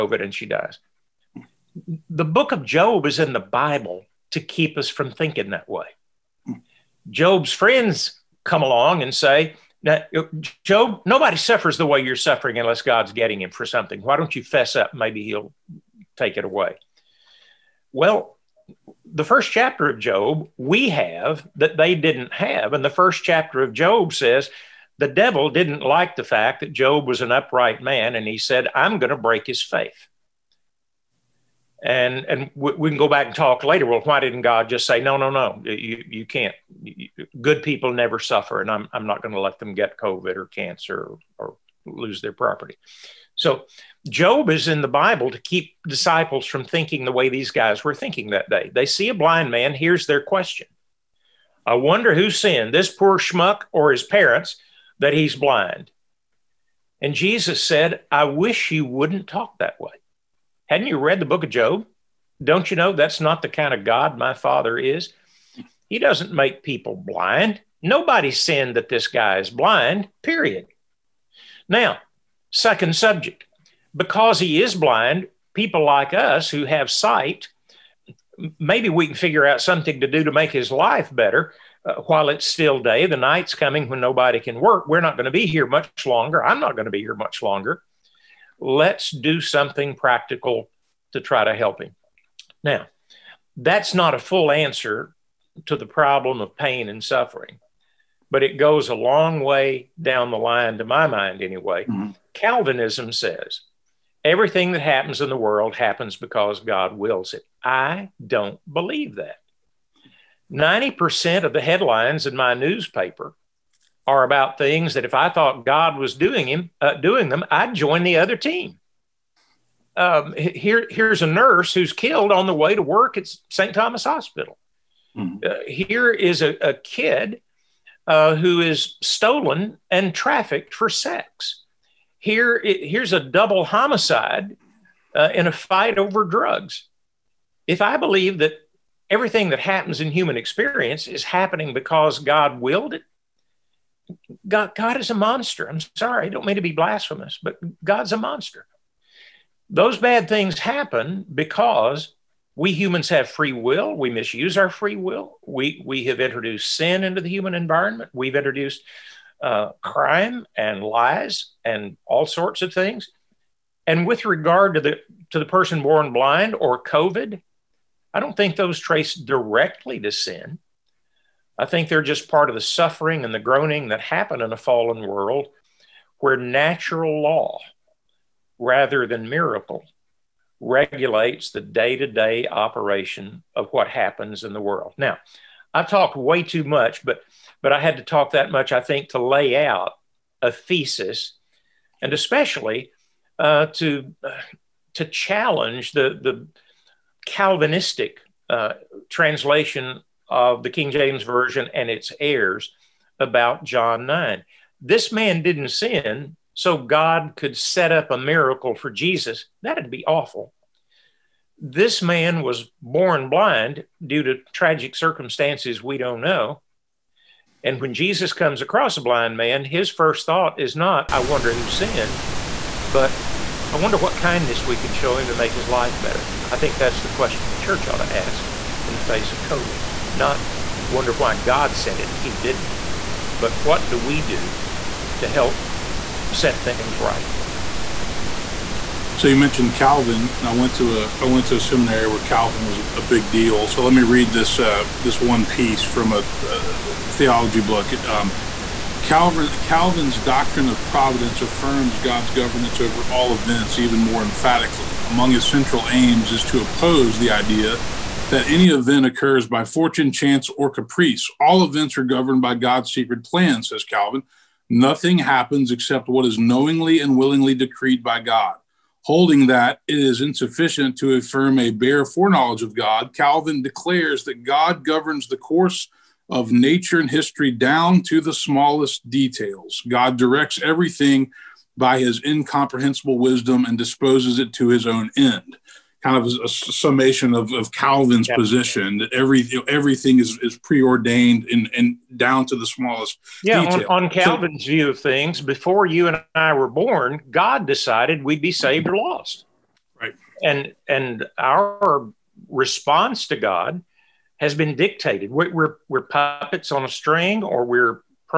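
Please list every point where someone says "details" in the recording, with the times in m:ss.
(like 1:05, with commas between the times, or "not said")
4:39, 4:53.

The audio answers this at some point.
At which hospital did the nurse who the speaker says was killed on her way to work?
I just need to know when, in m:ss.
2:03.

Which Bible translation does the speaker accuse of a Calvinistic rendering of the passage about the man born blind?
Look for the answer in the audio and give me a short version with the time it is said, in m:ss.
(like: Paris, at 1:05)
King James Version, at 3:20.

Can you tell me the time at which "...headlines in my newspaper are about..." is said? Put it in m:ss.
1:51.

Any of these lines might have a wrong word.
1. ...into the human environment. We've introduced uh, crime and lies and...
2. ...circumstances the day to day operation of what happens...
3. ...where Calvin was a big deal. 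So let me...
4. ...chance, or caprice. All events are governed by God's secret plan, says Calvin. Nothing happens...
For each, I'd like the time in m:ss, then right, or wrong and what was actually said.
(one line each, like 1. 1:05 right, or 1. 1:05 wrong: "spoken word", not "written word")
1. 2:37 right
2. 3:00 wrong: "regulates", not "circumstances"
3. 4:02 right
4. 4:20 right.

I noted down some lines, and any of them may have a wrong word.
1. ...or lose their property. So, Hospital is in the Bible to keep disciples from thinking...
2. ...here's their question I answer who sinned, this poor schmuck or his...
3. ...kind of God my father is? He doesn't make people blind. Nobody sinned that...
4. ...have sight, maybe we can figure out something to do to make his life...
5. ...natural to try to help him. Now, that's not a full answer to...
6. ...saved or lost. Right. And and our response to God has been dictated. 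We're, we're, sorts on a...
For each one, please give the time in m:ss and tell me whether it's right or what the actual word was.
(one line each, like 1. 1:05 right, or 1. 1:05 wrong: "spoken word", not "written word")
1. 0:41 wrong: "Job", not "Hospital"
2. 0:49 wrong: "wonder", not "answer"
3. 1:03 right
4. 1:16 right
5. 1:29 wrong: "practical", not "natural"
6. 4:58 wrong: "puppets", not "sorts".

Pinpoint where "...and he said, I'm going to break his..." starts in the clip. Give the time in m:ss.
0:28.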